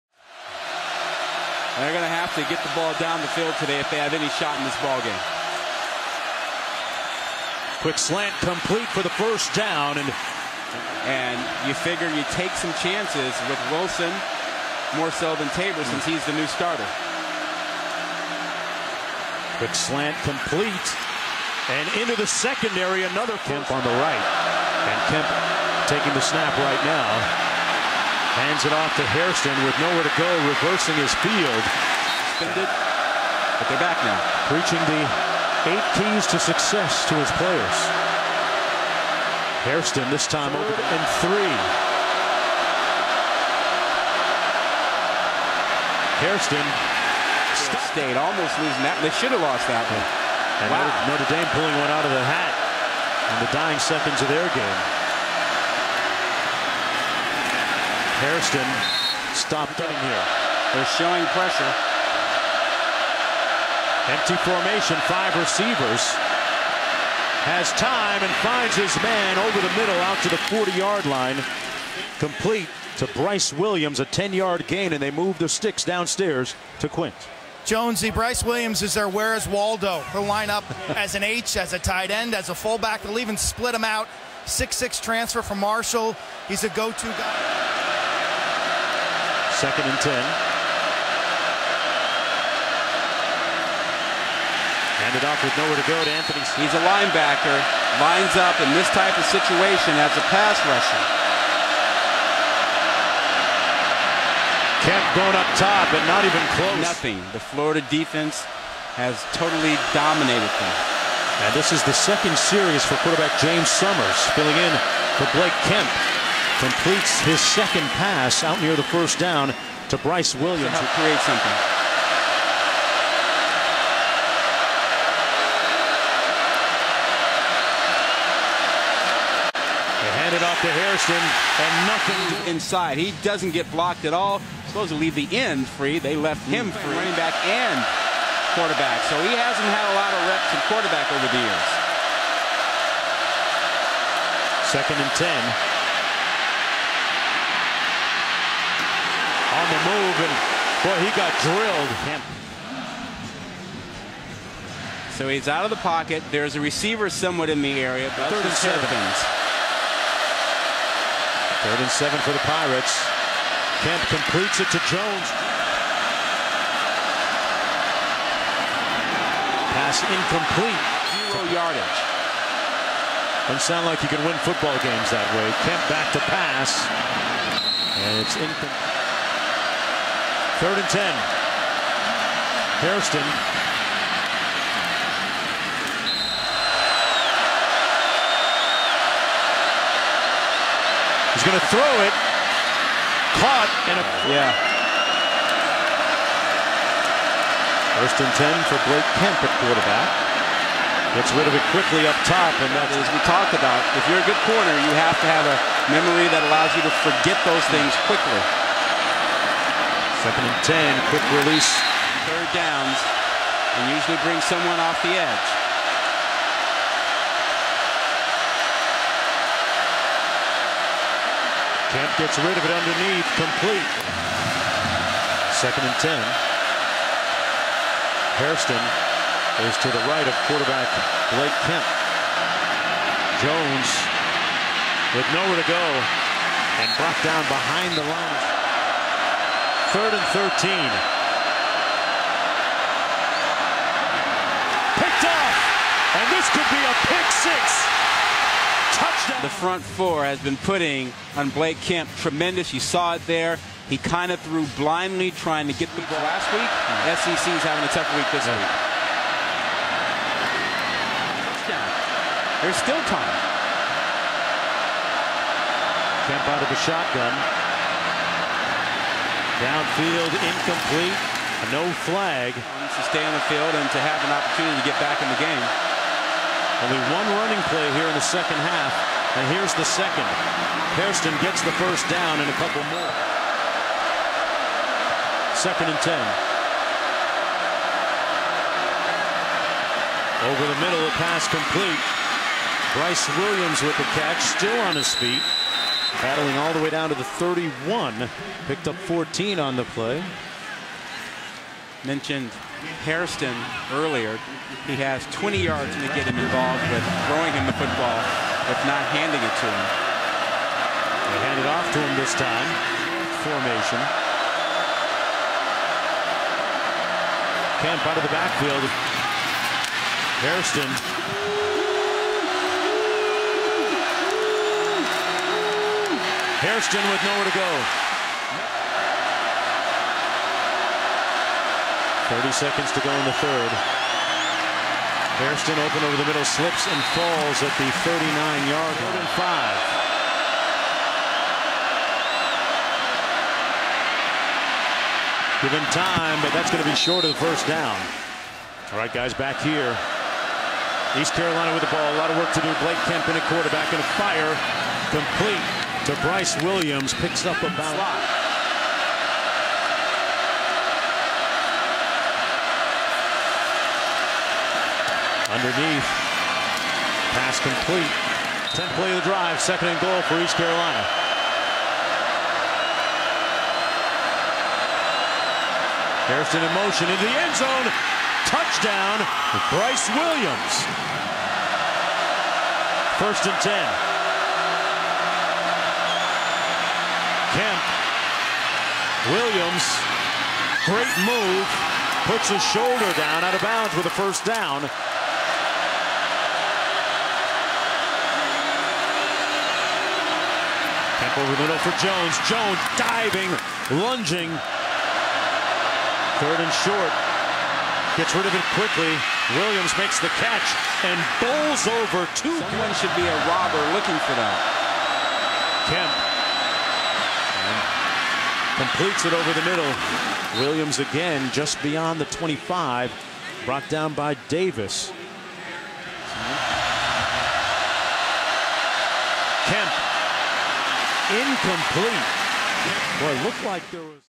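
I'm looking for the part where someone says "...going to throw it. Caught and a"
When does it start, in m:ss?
3:11.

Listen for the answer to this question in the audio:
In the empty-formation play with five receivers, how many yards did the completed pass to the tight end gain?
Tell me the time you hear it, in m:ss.
1:13.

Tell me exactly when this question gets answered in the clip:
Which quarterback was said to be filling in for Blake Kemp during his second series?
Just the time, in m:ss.
1:53.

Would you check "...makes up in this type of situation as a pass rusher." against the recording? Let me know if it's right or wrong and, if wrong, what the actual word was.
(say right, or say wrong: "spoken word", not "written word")
wrong: "lines", not "makes".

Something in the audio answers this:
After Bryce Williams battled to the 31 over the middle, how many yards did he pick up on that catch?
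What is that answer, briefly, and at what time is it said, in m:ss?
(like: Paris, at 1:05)
14, at 4:58.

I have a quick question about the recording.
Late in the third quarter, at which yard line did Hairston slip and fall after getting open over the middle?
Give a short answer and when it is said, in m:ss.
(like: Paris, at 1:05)
39-yard line, at 5:38.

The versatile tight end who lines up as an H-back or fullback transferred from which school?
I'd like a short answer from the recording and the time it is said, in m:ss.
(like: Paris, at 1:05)
Marshall, at 1:25.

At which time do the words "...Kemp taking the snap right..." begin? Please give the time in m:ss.
0:25.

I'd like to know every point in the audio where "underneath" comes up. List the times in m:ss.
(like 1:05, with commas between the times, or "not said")
3:42, 6:05.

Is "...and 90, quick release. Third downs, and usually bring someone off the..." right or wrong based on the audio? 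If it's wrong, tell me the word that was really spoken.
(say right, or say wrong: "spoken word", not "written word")
wrong: "10", not "90".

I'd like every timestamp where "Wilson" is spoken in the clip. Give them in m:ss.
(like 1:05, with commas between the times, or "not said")
0:13.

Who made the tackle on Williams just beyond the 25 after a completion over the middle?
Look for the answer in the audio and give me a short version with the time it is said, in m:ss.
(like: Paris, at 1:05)
Davis, at 7:04.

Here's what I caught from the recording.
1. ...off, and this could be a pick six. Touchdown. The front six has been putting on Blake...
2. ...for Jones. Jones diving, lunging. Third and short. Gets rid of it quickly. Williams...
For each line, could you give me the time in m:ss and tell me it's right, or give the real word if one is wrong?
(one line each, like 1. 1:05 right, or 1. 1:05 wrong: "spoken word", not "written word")
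1. 4:05 wrong: "four", not "six"
2. 6:41 right.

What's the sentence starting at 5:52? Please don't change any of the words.
Blake Kemp in a quarterback and a fire complete to Bryce Williams.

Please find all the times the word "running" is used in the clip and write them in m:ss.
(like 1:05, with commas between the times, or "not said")
2:16, 4:37.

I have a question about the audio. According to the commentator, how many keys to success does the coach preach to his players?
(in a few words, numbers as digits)
8.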